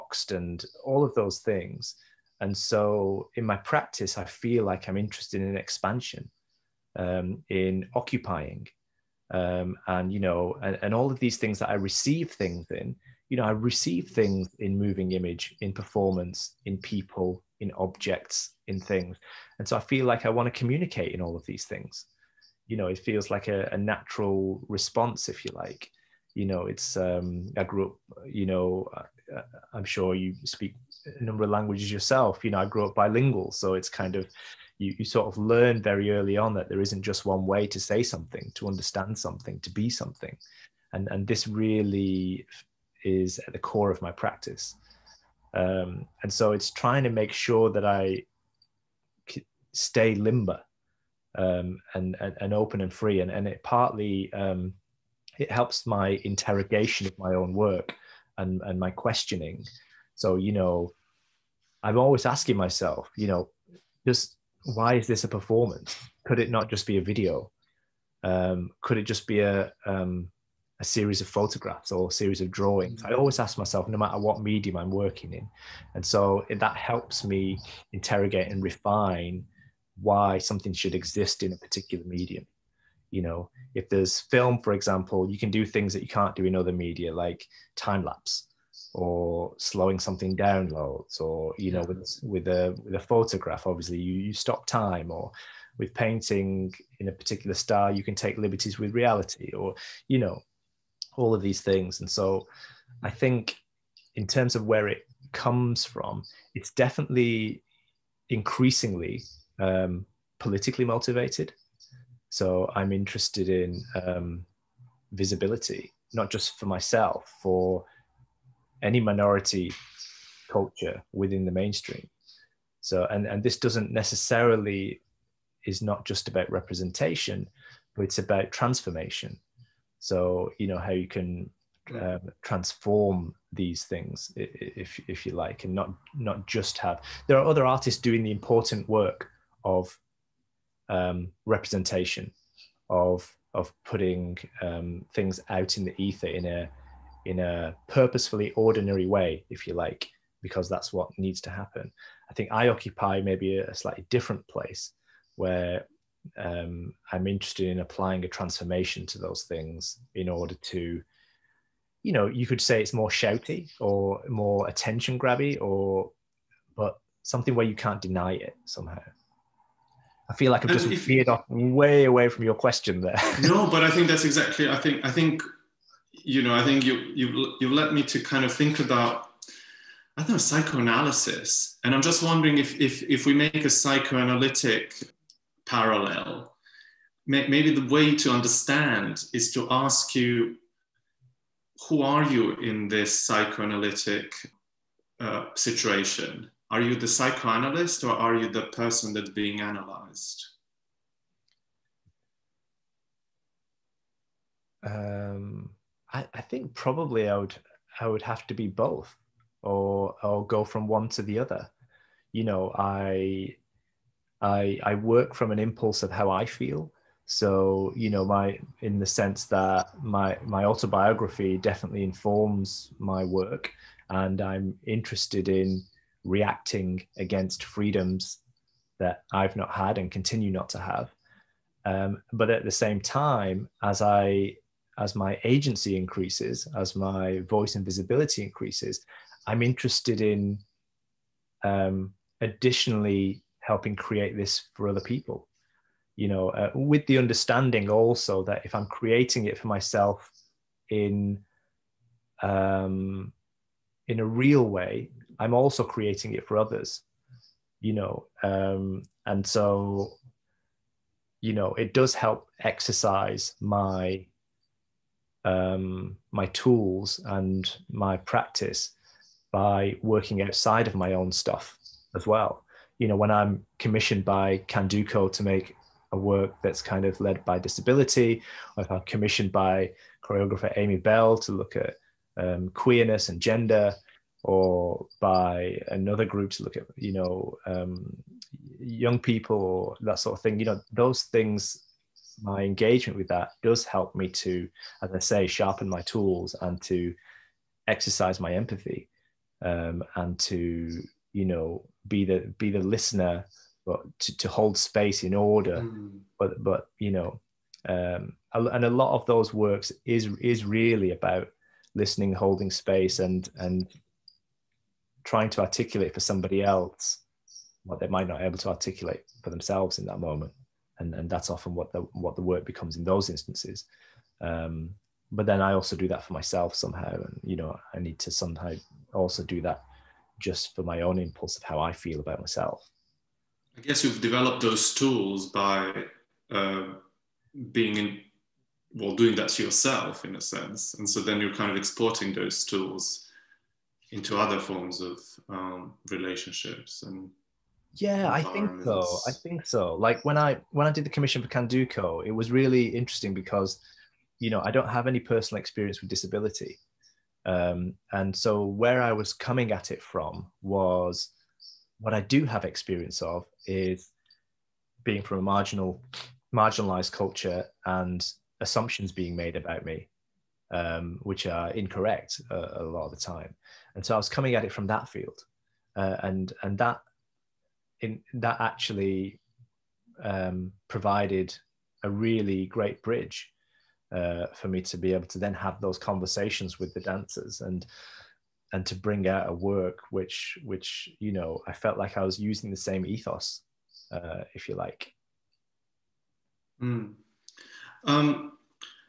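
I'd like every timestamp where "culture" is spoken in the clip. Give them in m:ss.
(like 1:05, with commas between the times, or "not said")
2:00, 6:07.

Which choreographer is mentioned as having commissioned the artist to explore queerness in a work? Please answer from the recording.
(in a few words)
Amy Bell.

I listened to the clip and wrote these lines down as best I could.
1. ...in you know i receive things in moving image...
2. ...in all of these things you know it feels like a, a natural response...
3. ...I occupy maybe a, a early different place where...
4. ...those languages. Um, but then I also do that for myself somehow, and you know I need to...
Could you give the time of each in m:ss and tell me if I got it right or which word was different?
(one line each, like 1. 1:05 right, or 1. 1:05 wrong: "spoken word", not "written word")
1. 0:12 right
2. 0:21 right
3. 2:32 wrong: "slightly", not "early"
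4. 5:23 wrong: "instances", not "languages".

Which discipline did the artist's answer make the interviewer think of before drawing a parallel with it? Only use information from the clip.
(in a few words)
psychoanalysis.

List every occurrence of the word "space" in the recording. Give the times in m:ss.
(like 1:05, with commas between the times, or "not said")
5:04, 5:12.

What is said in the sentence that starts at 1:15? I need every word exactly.
And so that helps me interrogate and refine why something should exist in a particular medium.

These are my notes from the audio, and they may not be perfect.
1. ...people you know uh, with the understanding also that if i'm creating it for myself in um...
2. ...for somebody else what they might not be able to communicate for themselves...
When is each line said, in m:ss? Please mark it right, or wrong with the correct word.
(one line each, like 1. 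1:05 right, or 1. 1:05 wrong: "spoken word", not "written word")
1. 4:04 right
2. 5:16 wrong: "articulate", not "communicate".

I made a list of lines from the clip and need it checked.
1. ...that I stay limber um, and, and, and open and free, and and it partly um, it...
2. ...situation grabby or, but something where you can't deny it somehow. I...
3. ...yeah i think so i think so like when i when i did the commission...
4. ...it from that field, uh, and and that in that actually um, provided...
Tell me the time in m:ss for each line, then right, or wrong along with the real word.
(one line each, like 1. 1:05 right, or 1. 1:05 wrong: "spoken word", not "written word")
1. 0:47 right
2. 2:44 wrong: "attention", not "situation"
3. 5:47 right
4. 6:14 right.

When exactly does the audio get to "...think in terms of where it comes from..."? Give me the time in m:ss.
1:43.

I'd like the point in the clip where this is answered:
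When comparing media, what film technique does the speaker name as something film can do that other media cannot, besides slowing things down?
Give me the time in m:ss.
1:27.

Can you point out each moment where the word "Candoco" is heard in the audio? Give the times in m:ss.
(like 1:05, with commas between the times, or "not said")
4:34, 5:51.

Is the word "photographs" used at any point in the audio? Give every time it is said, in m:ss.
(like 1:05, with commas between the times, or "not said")
1:11, 1:32.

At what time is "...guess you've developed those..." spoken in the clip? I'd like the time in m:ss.
5:33.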